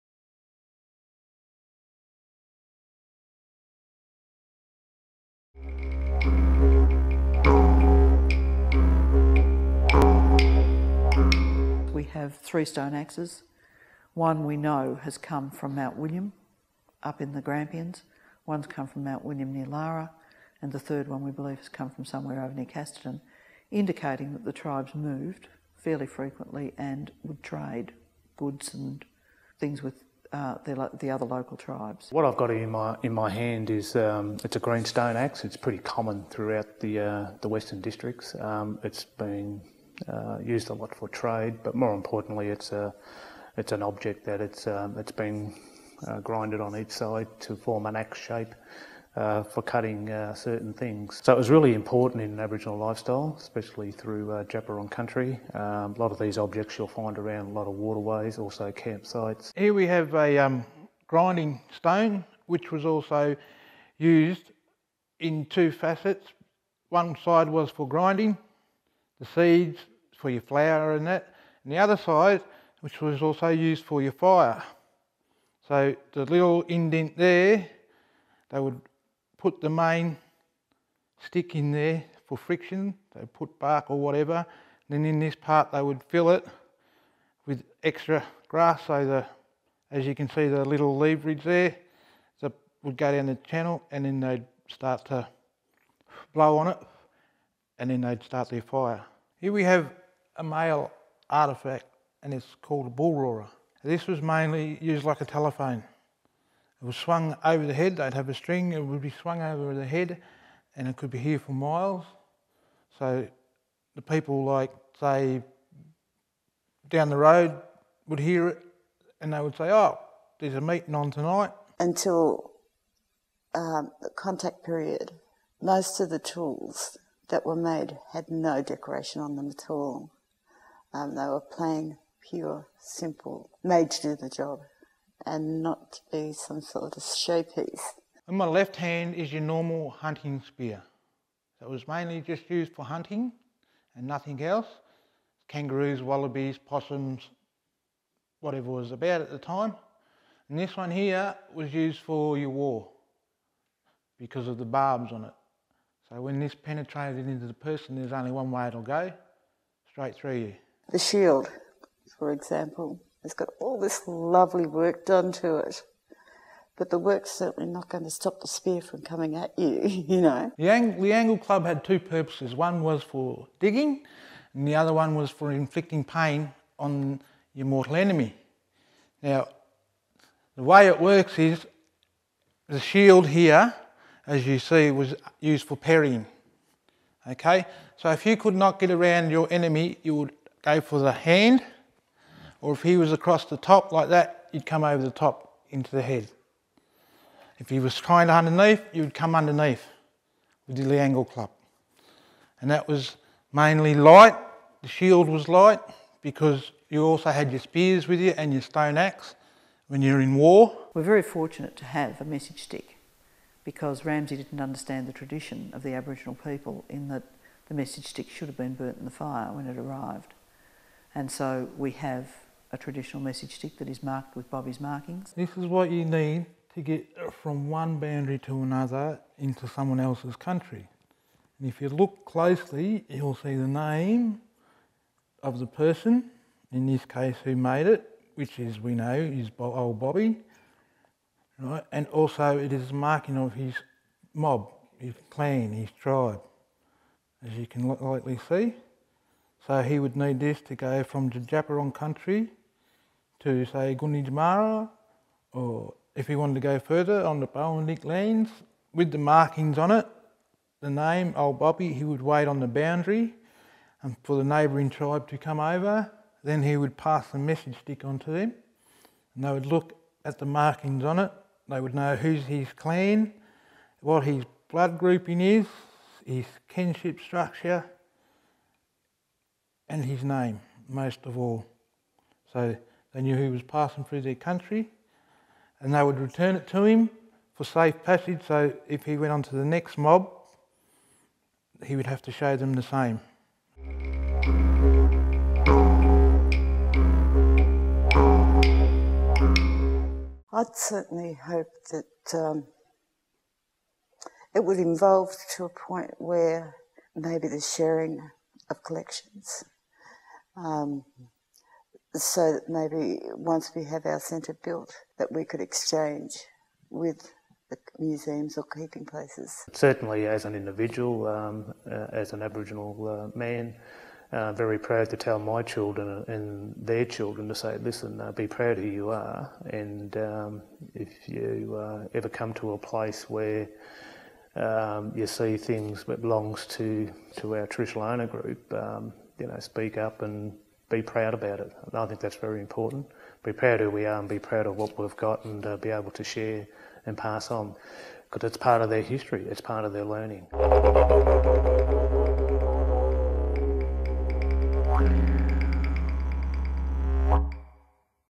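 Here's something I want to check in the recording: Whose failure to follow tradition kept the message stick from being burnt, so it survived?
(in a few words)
Ramsey.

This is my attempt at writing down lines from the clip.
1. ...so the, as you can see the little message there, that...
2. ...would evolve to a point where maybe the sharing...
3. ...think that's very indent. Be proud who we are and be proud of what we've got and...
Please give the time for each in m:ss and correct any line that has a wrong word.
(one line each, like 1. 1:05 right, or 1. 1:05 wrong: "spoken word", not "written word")
1. 1:28 wrong: "leverage", not "message"
2. 5:04 right
3. 5:42 wrong: "important", not "indent".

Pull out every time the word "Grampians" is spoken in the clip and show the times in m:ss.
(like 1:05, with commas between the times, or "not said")
0:17.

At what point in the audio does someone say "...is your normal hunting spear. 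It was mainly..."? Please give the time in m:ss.
2:19.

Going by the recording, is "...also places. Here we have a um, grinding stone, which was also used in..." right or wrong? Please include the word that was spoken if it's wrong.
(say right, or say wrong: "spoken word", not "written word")
wrong: "campsites", not "places".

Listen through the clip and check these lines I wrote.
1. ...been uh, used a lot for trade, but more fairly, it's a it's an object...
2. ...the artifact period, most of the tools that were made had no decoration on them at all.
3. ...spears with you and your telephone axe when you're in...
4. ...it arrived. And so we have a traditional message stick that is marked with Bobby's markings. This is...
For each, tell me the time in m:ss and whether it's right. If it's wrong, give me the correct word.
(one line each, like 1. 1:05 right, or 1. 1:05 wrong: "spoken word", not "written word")
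1. 0:39 wrong: "importantly", not "fairly"
2. 2:04 wrong: "contact", not "artifact"
3. 3:27 wrong: "stone", not "telephone"
4. 3:39 right.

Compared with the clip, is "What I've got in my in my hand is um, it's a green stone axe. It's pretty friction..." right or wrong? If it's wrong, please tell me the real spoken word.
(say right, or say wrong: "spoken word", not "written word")
wrong: "common", not "friction".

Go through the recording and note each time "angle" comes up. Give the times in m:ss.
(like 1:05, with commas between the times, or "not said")
2:51, 3:20.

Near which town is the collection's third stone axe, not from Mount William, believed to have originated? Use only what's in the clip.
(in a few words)
Casterton.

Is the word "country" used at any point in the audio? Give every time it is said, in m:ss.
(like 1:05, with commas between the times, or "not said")
0:54, 3:50, 4:11, 4:44.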